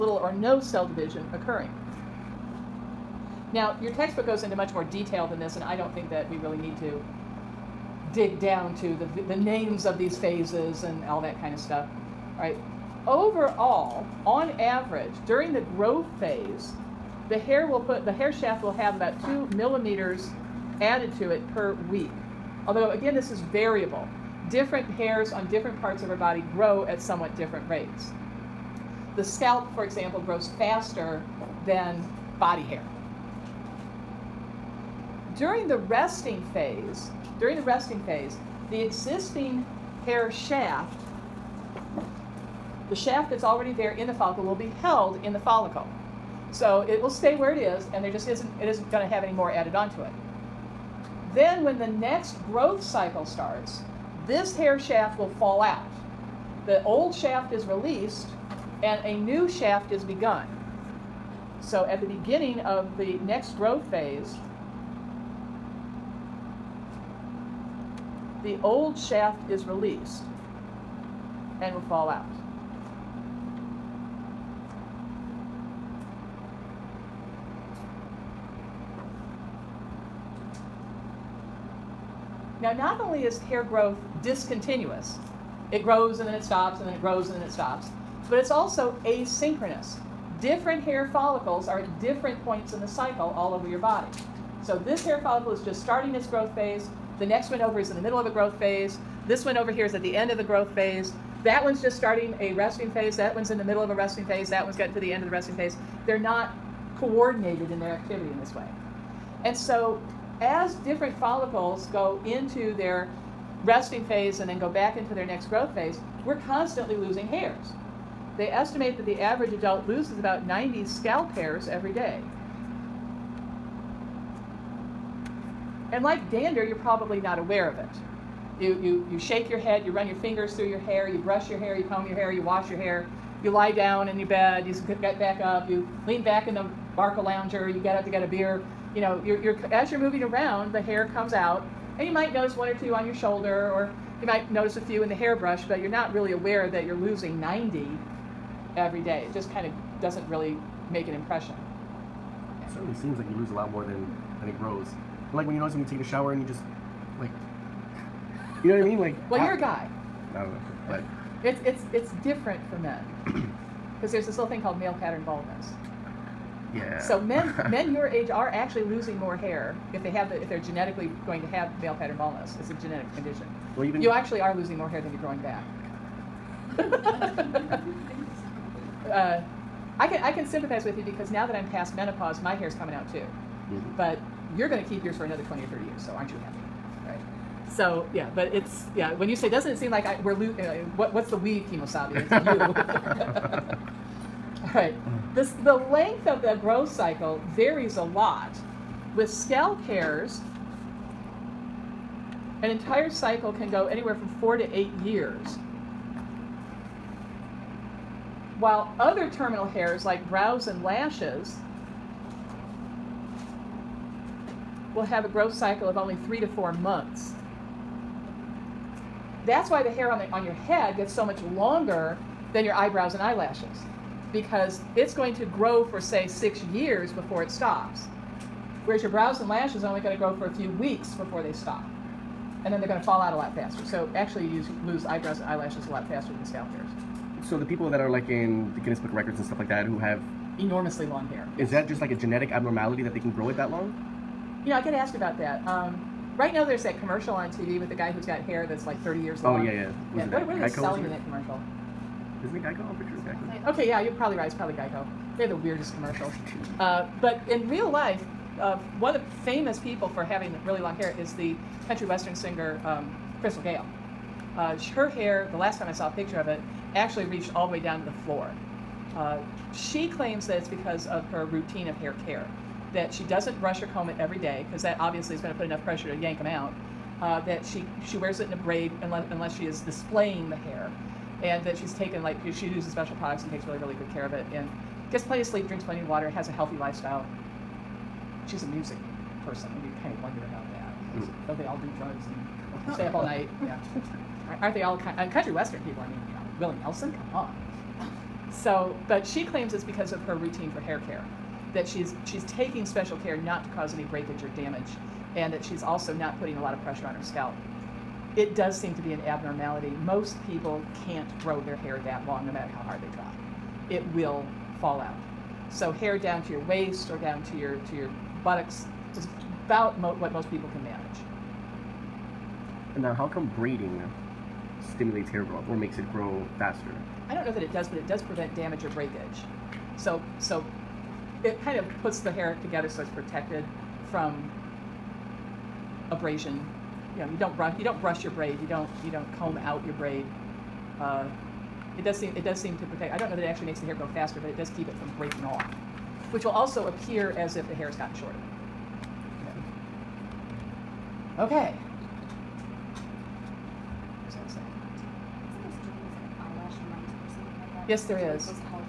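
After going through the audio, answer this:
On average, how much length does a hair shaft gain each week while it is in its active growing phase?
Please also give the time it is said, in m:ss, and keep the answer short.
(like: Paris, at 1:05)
2 millimeters, at 0:19.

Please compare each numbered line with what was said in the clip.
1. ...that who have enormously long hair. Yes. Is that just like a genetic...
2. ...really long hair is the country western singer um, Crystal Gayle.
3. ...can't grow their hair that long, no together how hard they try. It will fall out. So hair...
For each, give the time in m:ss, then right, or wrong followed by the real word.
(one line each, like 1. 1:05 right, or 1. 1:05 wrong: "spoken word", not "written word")
1. 3:59 right
2. 4:20 right
3. 5:11 wrong: "matter", not "together".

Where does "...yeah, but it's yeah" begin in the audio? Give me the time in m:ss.
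3:08.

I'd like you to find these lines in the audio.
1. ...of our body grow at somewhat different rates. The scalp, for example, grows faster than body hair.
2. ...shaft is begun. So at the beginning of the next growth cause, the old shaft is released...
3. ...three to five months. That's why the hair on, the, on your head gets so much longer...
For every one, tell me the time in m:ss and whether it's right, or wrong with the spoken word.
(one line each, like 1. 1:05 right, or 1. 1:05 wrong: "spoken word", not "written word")
1. 0:26 right
2. 0:59 wrong: "phase", not "cause"
3. 3:36 wrong: "four", not "five".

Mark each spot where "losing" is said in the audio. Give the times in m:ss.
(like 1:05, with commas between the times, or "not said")
1:56, 2:26, 2:48, 2:54.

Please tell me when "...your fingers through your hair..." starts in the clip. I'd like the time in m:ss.
2:10.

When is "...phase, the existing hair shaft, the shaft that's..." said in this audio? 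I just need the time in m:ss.
0:38.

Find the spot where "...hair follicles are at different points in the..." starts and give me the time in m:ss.
1:30.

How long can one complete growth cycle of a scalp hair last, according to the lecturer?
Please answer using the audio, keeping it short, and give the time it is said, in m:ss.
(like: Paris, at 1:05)
4 to 8 years, at 3:24.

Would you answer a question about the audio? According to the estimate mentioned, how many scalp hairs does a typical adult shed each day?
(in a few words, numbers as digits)
90.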